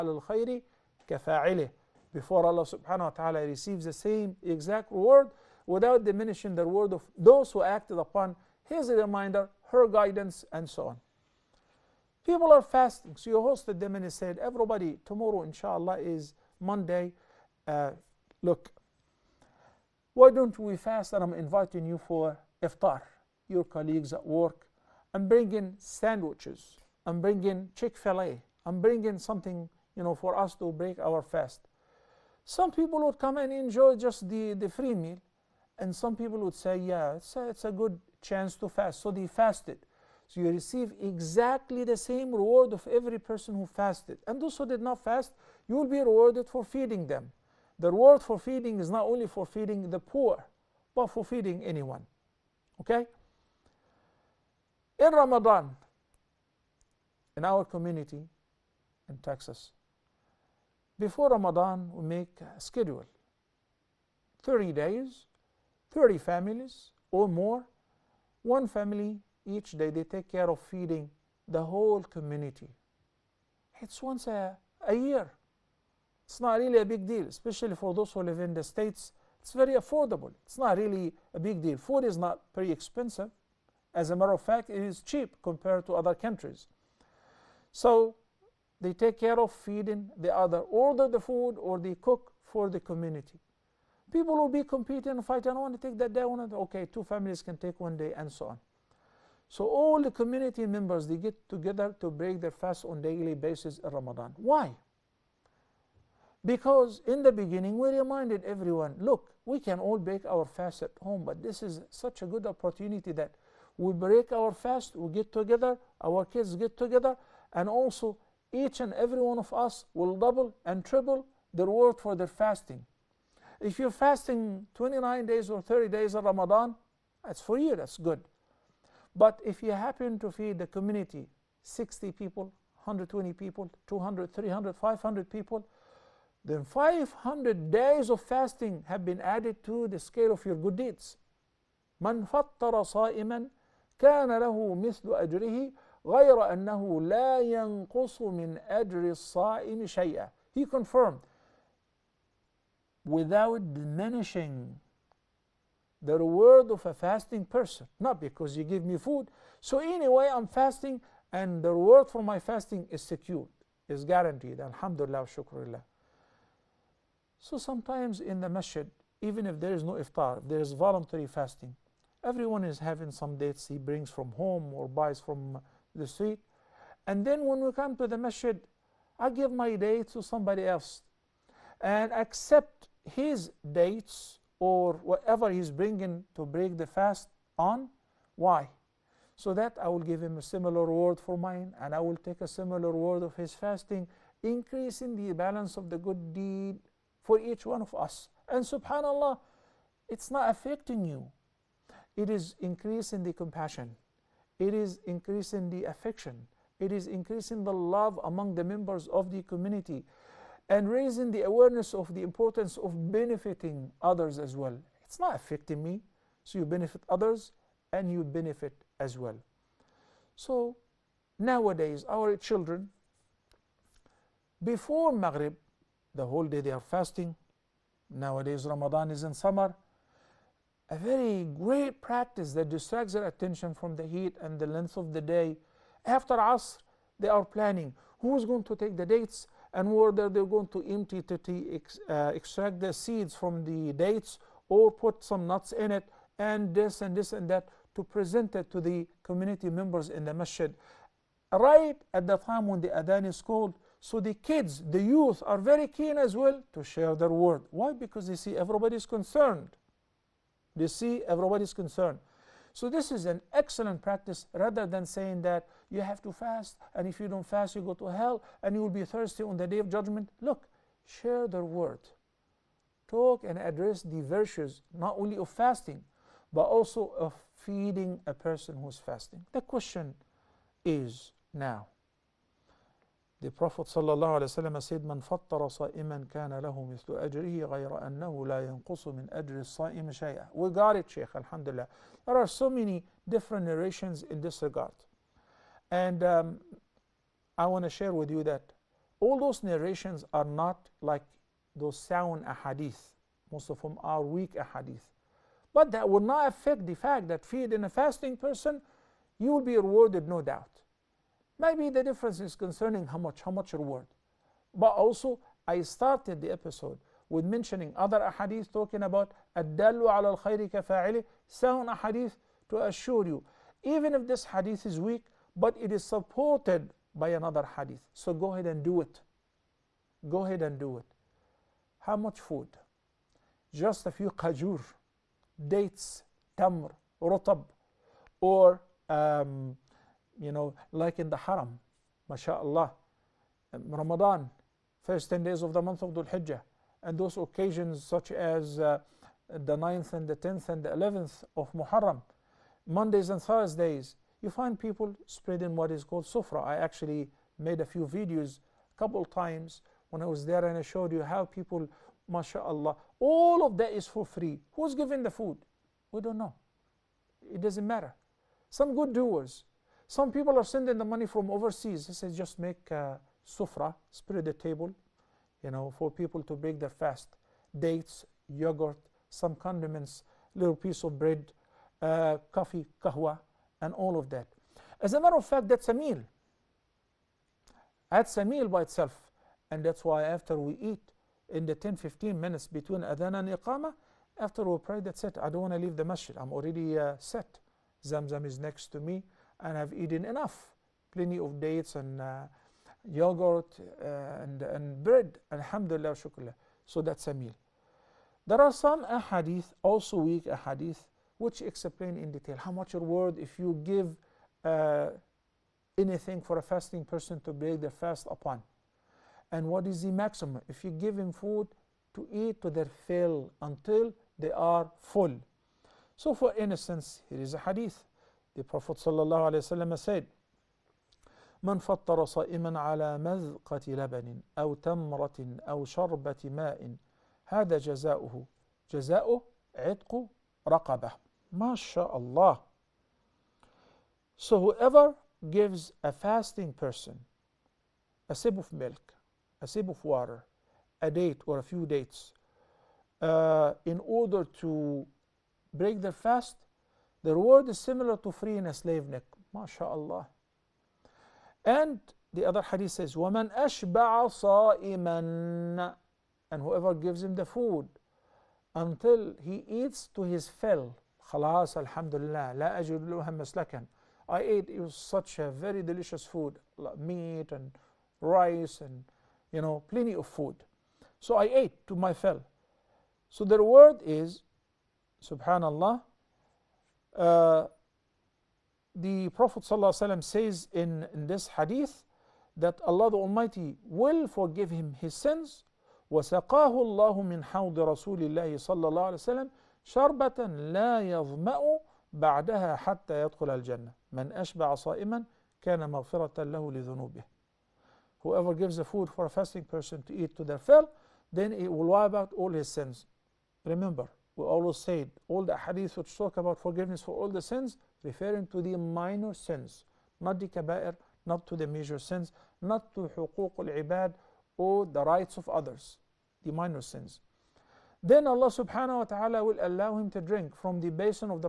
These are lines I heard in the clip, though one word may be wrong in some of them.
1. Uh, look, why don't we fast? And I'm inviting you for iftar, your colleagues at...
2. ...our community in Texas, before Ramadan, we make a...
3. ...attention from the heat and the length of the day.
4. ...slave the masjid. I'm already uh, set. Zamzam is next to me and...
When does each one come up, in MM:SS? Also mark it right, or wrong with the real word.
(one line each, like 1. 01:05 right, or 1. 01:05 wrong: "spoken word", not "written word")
1. 00:17 right
2. 00:57 right
3. 03:53 right
4. 06:35 wrong: "leave", not "slave".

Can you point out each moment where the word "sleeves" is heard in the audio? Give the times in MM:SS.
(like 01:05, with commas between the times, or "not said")
not said.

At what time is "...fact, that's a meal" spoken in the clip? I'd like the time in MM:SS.
06:25.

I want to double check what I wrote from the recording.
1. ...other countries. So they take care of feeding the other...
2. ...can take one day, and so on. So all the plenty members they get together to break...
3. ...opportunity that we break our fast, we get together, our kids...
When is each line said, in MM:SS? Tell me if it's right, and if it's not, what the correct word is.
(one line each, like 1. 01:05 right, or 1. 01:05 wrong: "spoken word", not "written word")
1. 01:25 right
2. 01:37 wrong: "community", not "plenty"
3. 01:52 right.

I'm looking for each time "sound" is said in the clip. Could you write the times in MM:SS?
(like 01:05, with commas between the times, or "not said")
05:01, 05:21.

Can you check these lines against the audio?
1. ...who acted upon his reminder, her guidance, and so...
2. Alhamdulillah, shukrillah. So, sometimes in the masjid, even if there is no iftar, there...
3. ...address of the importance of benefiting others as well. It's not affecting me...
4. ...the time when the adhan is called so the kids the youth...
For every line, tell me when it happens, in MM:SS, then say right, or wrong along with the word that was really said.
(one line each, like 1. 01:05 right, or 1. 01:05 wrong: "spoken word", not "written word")
1. 00:07 right
2. 02:44 right
3. 03:31 wrong: "awareness", not "address"
4. 04:12 right.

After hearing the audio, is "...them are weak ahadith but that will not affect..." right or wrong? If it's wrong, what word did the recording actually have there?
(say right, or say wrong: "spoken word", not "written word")
right.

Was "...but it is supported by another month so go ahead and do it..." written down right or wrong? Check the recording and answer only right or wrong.
wrong.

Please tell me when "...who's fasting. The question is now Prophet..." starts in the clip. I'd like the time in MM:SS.
04:38.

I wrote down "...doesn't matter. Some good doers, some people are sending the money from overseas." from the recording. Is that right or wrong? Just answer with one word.
right.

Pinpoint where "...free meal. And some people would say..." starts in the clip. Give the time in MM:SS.
00:34.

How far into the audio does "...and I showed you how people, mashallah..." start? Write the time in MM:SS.
06:00.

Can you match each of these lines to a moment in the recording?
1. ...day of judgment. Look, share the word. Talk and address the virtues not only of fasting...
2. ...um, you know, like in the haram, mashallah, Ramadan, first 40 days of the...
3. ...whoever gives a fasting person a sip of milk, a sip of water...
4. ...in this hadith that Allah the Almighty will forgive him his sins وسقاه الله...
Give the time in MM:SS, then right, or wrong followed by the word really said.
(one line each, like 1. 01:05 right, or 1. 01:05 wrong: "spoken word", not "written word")
1. 04:29 right
2. 05:39 wrong: "10", not "40"
3. 07:24 right
4. 08:11 right.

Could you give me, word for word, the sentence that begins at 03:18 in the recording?
And subhanAllah, it's not affecting you.